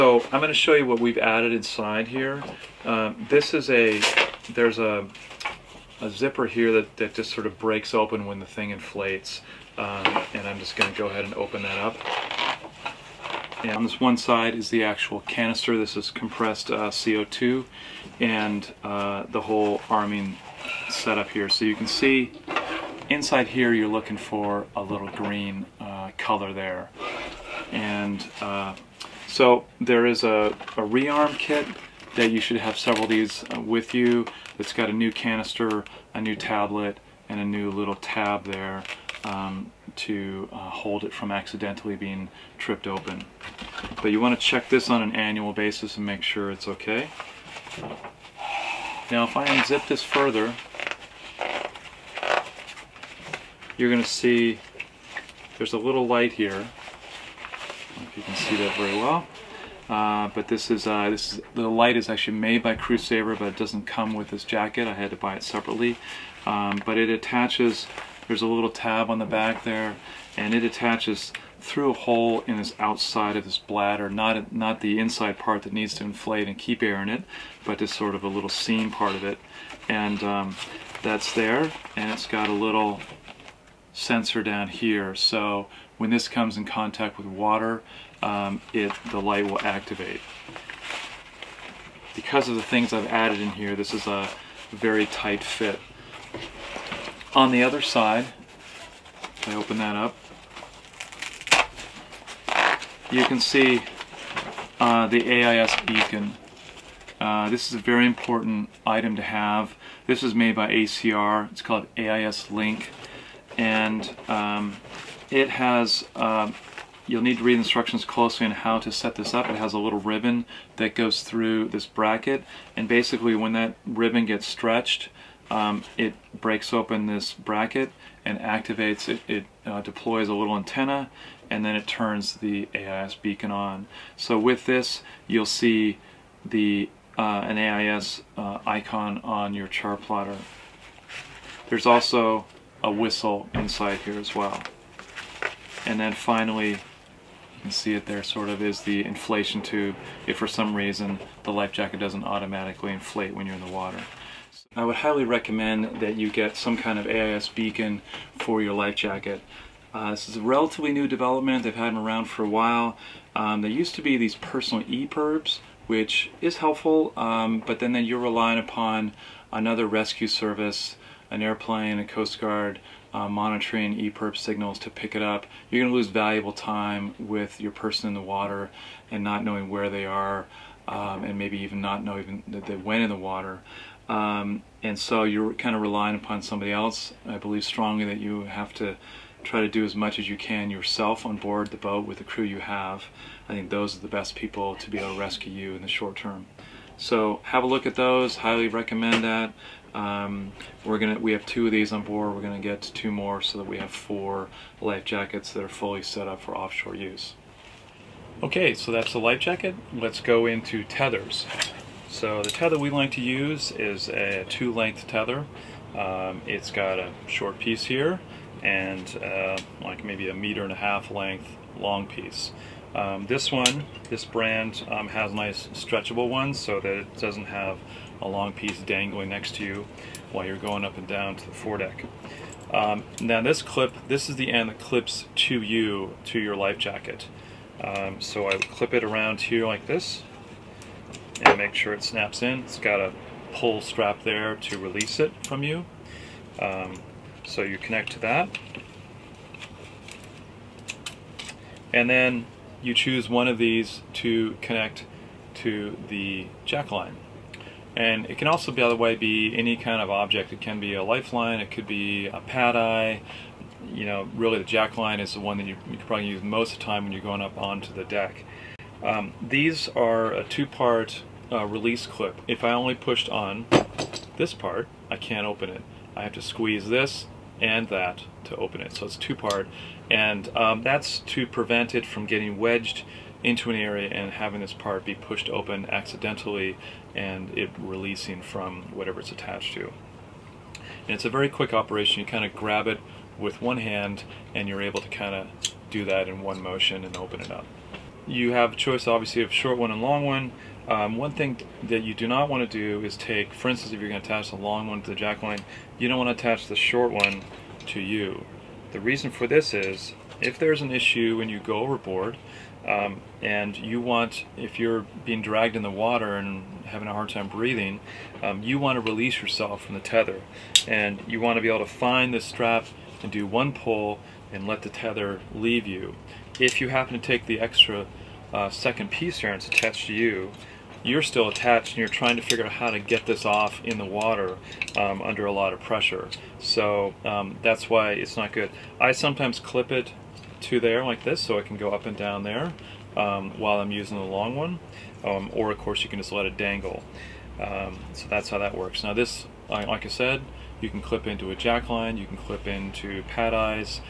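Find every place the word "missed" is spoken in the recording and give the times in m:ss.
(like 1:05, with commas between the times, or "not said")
not said.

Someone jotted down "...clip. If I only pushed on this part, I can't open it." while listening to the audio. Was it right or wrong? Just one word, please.
right.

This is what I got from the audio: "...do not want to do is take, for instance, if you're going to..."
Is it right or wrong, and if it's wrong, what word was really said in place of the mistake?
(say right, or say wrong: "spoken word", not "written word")
right.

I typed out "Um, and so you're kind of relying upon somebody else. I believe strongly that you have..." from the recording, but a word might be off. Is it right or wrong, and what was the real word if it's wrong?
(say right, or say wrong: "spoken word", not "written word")
right.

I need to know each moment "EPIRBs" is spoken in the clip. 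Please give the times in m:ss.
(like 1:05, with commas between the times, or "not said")
2:44, 2:53.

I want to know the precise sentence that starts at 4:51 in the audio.
And it's a very quick operation.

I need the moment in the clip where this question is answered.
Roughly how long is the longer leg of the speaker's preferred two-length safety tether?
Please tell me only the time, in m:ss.
3:40.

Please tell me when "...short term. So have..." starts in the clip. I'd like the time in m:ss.
3:15.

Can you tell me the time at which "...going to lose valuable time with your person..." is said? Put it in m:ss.
2:55.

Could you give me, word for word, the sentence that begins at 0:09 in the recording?
Um, and I'm just going to go ahead and open that up.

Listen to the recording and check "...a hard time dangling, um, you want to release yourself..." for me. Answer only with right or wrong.
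wrong.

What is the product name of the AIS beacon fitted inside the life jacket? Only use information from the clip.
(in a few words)
AIS Link.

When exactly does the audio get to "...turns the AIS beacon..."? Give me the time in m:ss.
2:11.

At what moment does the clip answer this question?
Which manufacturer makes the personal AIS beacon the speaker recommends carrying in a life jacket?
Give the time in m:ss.
1:50.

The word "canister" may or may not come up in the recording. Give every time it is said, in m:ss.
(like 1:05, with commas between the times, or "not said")
0:15, 0:35.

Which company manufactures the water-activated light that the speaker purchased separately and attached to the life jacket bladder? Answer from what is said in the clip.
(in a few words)
Crewsaver.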